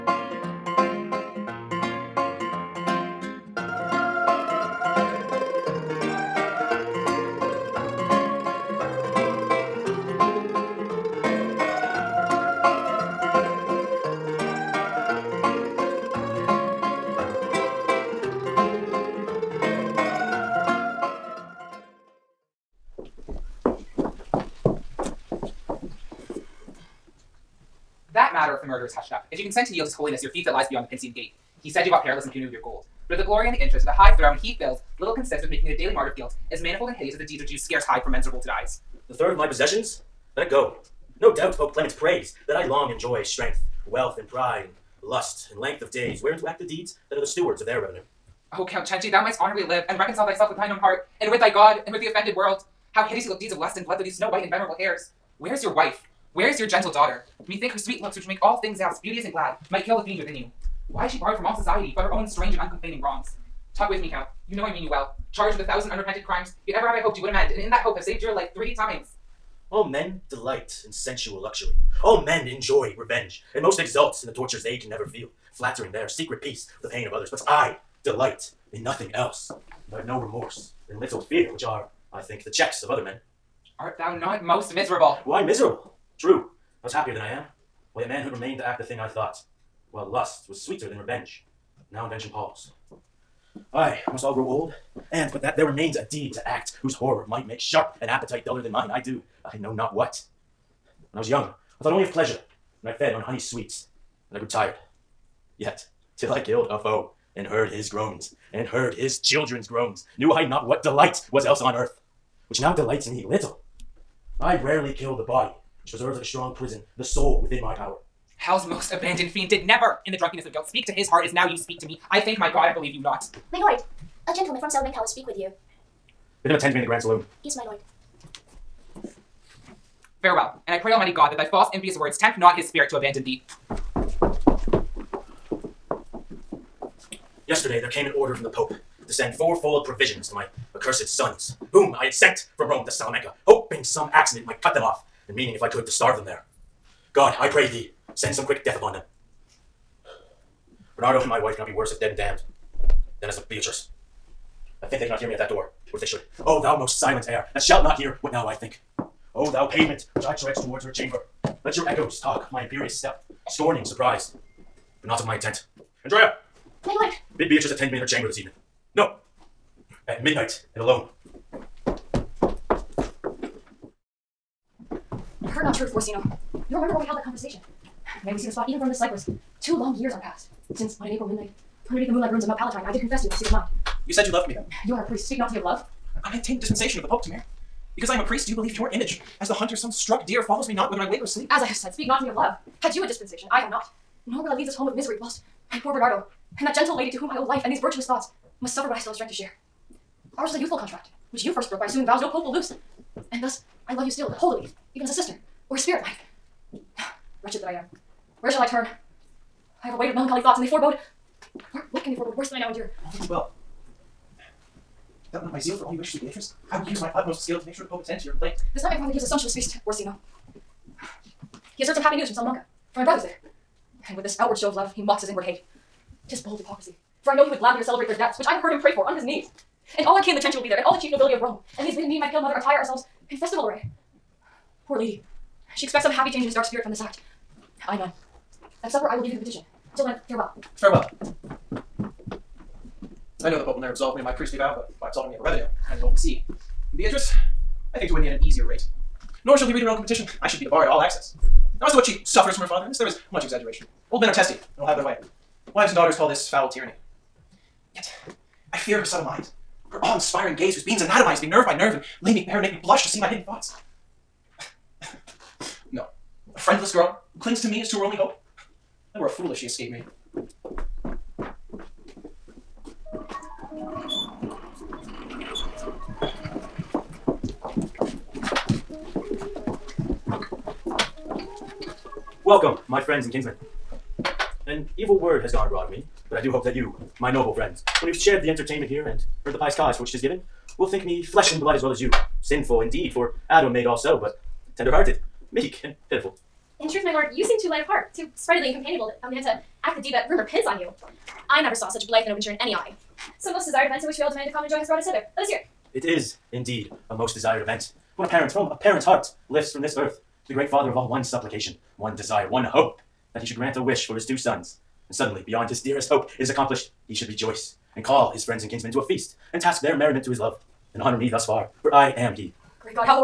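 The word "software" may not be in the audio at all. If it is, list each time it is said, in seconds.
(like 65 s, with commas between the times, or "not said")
not said.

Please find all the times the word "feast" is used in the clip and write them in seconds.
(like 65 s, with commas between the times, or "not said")
219 s, 319 s.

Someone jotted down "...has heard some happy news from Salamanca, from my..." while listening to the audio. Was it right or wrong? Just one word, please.
right.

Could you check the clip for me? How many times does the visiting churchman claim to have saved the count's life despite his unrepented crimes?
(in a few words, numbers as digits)
3.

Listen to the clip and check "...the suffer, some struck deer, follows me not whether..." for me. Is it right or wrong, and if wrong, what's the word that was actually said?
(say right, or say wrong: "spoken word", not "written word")
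wrong: "hunter", not "suffer".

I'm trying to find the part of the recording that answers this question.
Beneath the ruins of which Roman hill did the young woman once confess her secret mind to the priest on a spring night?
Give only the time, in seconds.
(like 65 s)
182 s.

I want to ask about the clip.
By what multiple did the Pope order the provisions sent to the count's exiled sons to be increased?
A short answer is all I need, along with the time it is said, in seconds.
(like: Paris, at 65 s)
Fourfold, at 139 s.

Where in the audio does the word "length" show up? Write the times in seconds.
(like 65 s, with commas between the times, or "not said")
45 s.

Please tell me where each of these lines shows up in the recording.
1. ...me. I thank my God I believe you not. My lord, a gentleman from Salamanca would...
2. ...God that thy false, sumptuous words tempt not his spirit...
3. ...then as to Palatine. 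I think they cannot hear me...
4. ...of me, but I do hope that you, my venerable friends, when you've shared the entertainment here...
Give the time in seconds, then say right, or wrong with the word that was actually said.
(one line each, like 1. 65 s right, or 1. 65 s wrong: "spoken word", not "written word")
1. 121 s right
2. 131 s wrong: "impious", not "sumptuous"
3. 153 s wrong: "Beatrice", not "Palatine"
4. 285 s wrong: "noble", not "venerable".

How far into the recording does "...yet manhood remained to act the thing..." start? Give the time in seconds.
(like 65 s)
88 s.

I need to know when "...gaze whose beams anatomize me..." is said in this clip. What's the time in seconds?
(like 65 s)
260 s.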